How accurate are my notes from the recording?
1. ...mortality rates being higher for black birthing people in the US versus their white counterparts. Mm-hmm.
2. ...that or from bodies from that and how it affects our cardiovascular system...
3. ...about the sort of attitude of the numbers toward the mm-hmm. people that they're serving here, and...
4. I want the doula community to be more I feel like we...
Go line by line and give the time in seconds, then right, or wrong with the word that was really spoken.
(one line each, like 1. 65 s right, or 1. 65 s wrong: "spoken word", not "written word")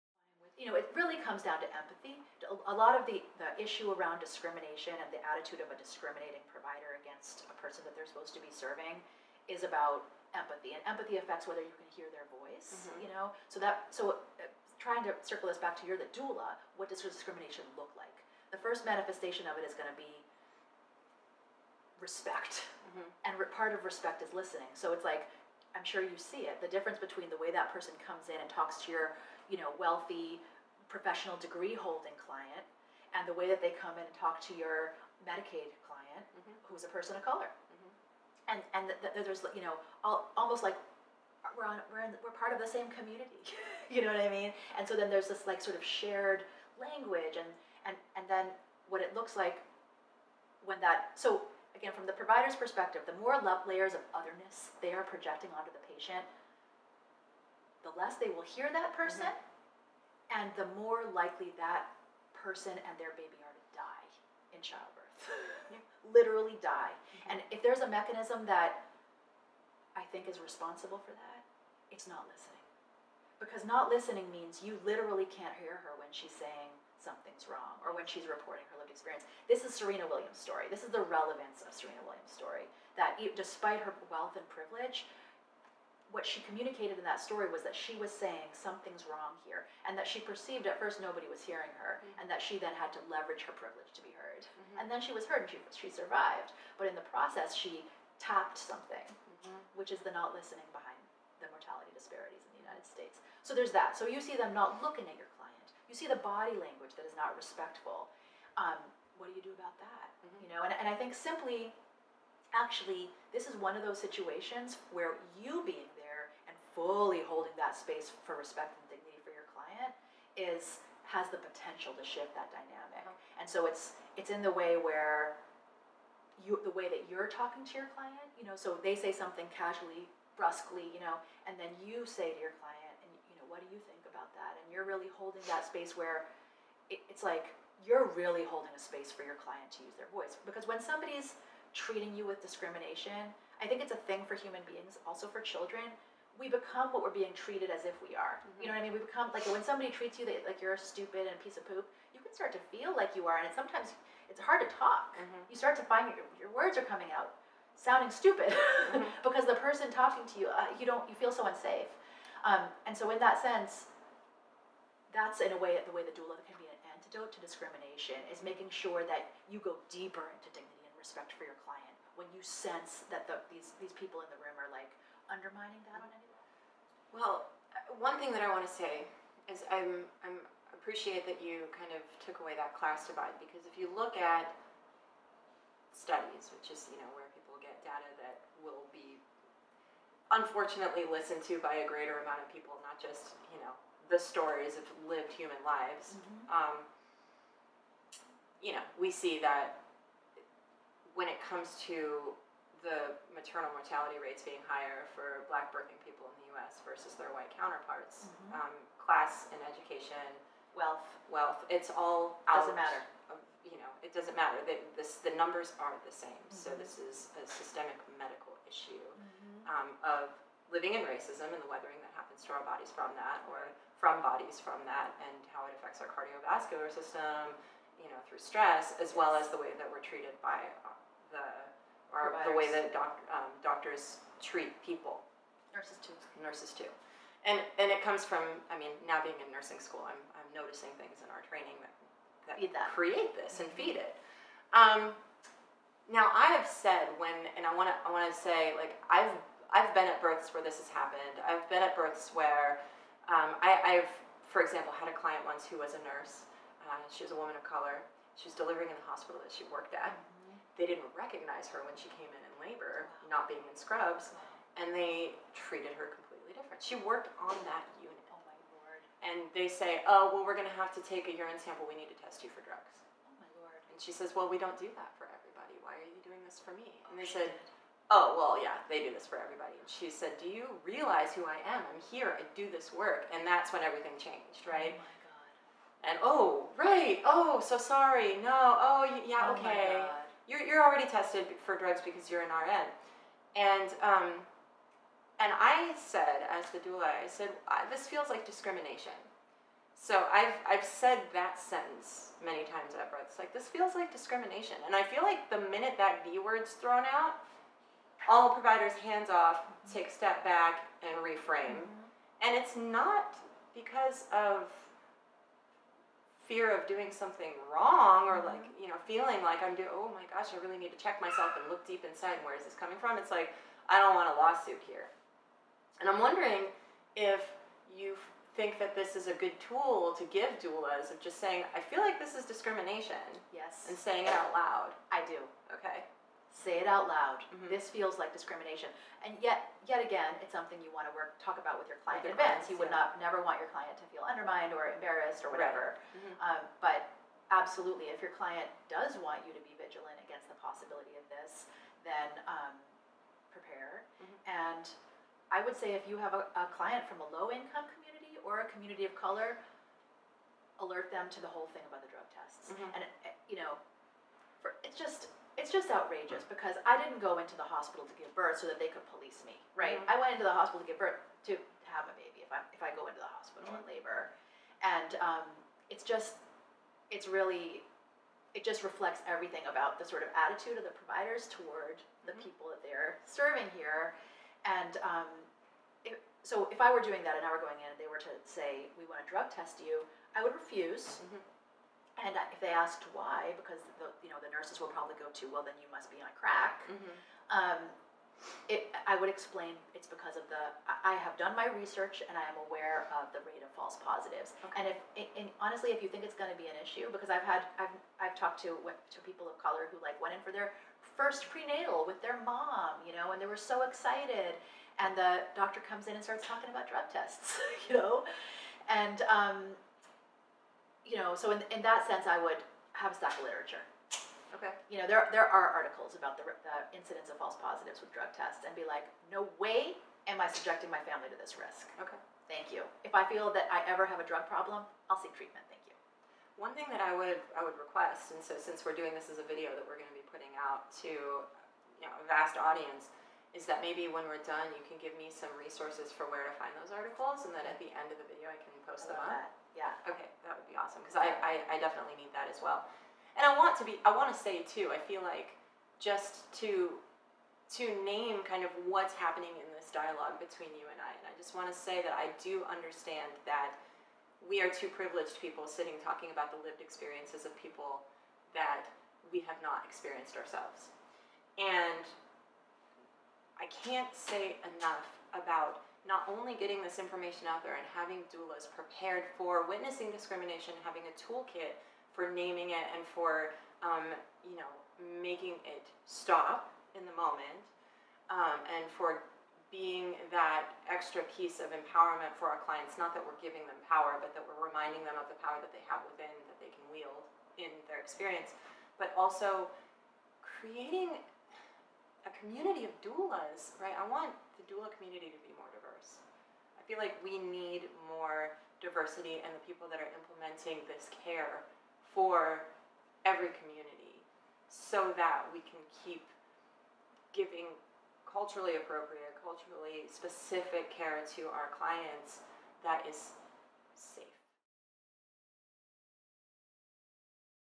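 1. 203 s right
2. 223 s right
3. 379 s wrong: "providers", not "numbers"
4. 503 s right.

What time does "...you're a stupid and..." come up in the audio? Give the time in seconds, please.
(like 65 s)
150 s.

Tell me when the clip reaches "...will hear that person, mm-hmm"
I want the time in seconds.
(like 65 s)
58 s.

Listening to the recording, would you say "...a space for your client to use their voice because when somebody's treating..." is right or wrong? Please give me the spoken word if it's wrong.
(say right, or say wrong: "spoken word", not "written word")
right.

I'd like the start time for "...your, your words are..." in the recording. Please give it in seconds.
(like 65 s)
156 s.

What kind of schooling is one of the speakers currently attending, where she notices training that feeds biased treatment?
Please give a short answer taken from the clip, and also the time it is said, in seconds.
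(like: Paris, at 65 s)
Nursing school, at 239 s.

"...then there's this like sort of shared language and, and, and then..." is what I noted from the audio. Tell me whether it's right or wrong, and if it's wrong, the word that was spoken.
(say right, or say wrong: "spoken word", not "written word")
right.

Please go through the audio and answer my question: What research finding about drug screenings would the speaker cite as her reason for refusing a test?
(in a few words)
Rate of false positives.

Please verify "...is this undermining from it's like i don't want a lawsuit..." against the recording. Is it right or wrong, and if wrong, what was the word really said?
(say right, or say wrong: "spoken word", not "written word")
wrong: "coming", not "undermining".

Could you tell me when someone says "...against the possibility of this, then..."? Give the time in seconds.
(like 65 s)
350 s.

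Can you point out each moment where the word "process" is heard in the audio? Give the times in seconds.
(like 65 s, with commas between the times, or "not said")
97 s.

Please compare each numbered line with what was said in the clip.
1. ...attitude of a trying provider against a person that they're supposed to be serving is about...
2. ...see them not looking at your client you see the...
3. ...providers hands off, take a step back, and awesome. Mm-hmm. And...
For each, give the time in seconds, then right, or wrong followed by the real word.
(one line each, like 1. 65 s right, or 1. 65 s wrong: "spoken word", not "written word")
1. 5 s wrong: "discriminating", not "trying"
2. 104 s right
3. 308 s wrong: "reframe", not "awesome".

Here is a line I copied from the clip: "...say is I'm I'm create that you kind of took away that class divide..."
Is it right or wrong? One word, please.
wrong.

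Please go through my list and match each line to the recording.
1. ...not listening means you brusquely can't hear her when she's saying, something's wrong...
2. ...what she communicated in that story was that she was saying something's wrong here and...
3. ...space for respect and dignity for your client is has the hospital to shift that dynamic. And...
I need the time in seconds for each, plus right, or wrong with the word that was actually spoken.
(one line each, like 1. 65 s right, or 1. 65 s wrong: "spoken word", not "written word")
1. 73 s wrong: "literally", not "brusquely"
2. 86 s right
3. 117 s wrong: "potential", not "hospital".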